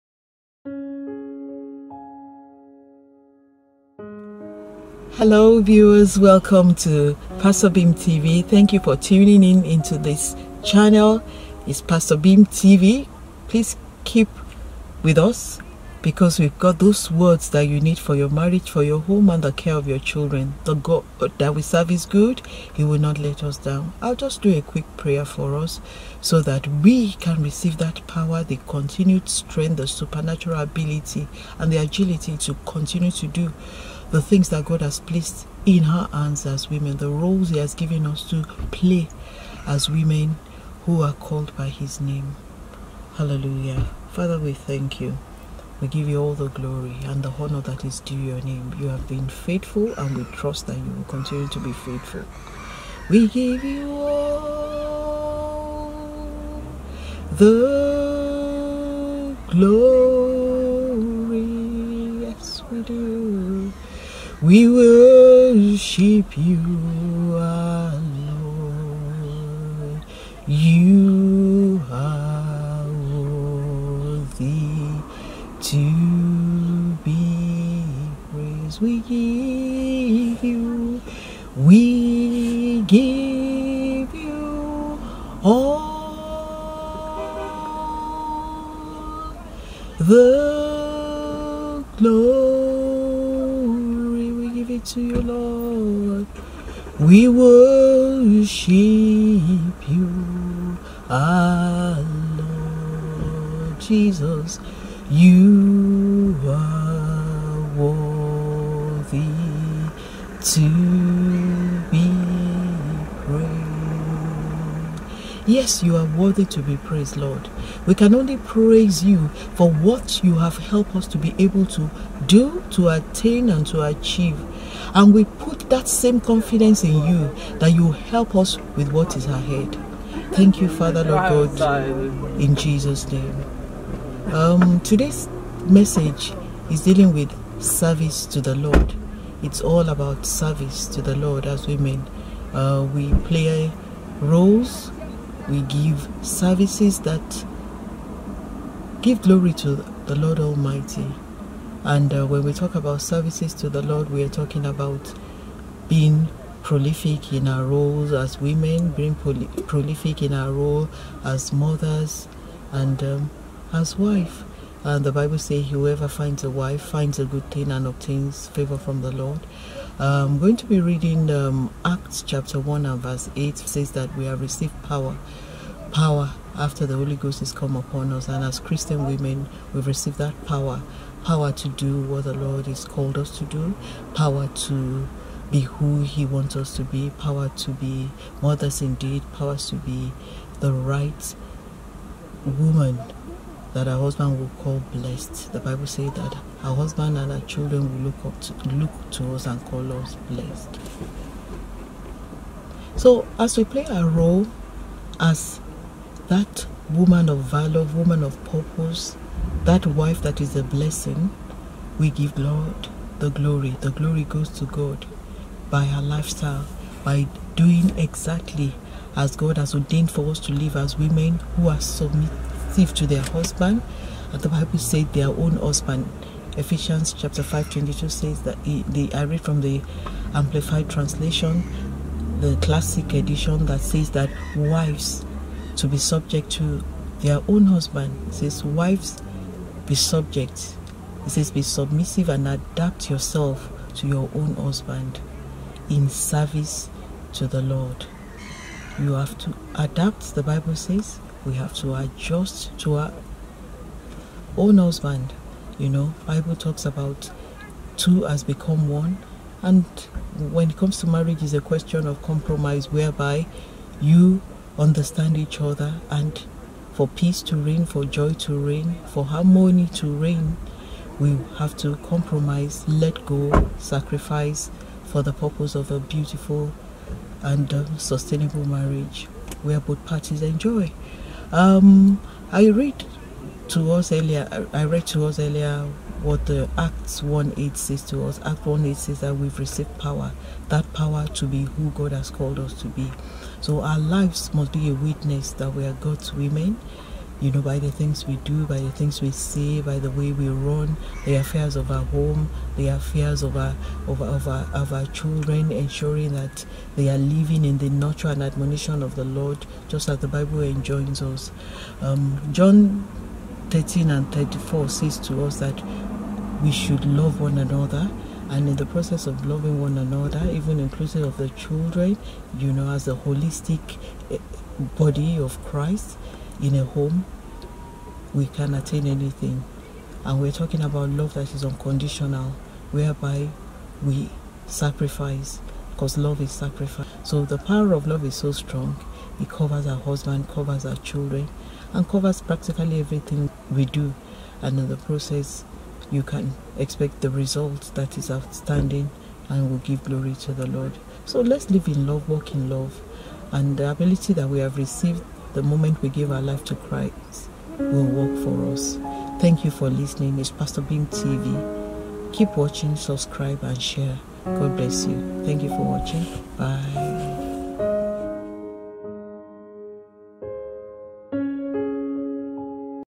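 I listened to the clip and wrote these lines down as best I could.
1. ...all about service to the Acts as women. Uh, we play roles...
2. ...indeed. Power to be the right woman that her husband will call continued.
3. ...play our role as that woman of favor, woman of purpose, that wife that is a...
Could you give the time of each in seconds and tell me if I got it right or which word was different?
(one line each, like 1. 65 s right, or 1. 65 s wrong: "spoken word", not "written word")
1. 139 s wrong: "Lord", not "Acts"
2. 188 s wrong: "blessed", not "continued"
3. 203 s wrong: "valor", not "favor".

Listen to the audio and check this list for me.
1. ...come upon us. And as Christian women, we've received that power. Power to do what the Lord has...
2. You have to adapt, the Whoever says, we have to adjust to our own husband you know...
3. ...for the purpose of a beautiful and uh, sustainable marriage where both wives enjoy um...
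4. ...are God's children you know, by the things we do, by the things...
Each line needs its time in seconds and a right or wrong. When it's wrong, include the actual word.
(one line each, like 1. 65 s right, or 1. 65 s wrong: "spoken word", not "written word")
1. 177 s right
2. 248 s wrong: "Bible", not "Whoever"
3. 275 s wrong: "parties", not "wives"
4. 295 s wrong: "women", not "children".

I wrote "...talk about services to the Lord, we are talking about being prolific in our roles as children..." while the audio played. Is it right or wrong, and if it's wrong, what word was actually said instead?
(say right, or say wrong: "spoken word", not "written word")
wrong: "women", not "children".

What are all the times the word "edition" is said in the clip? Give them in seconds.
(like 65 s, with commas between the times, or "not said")
233 s.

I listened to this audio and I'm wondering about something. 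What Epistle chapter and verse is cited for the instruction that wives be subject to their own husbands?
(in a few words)
Ephesians 5:22.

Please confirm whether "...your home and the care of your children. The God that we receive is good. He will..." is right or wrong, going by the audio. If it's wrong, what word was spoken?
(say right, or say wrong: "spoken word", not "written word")
wrong: "serve", not "receive".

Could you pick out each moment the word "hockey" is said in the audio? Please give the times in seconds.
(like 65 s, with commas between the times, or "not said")
not said.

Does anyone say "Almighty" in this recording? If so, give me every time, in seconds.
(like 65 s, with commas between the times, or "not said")
150 s.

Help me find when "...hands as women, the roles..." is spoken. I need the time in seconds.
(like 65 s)
36 s.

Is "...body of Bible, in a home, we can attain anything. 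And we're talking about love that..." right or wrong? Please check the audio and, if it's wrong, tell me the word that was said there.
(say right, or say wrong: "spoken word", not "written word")
wrong: "Christ", not "Bible".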